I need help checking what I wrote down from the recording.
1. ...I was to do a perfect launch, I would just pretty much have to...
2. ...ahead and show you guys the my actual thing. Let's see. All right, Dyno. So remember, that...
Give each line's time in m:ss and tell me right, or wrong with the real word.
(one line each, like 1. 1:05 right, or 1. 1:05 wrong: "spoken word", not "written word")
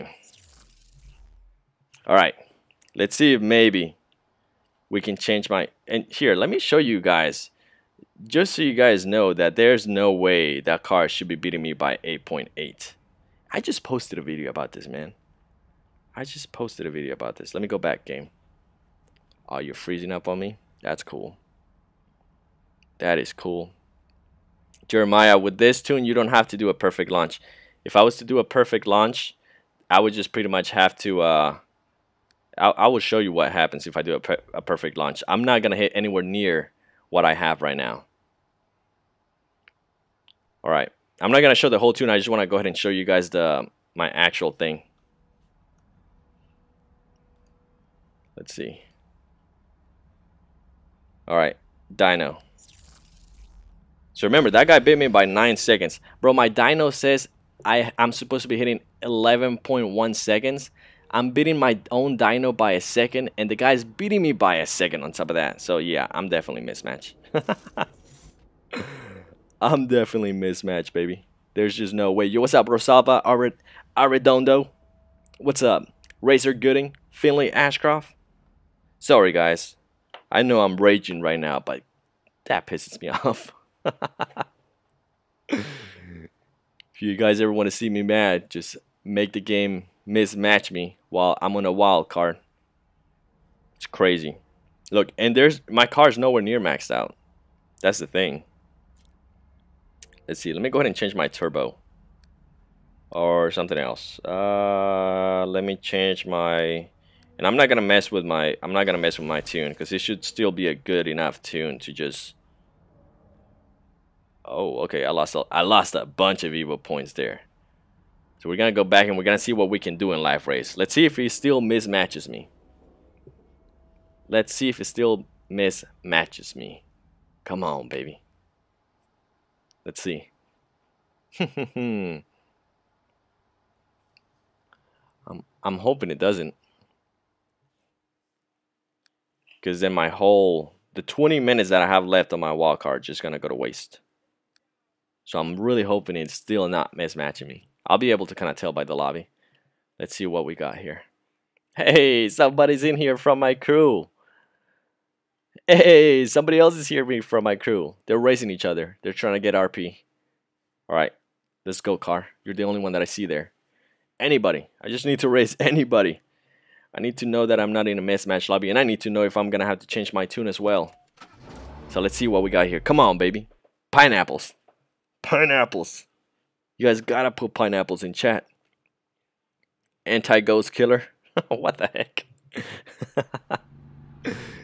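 1. 0:27 right
2. 0:42 right.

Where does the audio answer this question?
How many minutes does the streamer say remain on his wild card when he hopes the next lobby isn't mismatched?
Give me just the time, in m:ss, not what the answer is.
2:21.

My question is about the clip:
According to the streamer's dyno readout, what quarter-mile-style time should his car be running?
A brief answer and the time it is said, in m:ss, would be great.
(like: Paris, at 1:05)
11.1 seconds, at 0:59.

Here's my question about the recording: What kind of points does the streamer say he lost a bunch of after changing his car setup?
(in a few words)
evil points.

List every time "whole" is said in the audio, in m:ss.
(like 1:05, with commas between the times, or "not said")
0:41, 2:20.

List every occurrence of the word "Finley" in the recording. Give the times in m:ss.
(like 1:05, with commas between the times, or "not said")
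1:17.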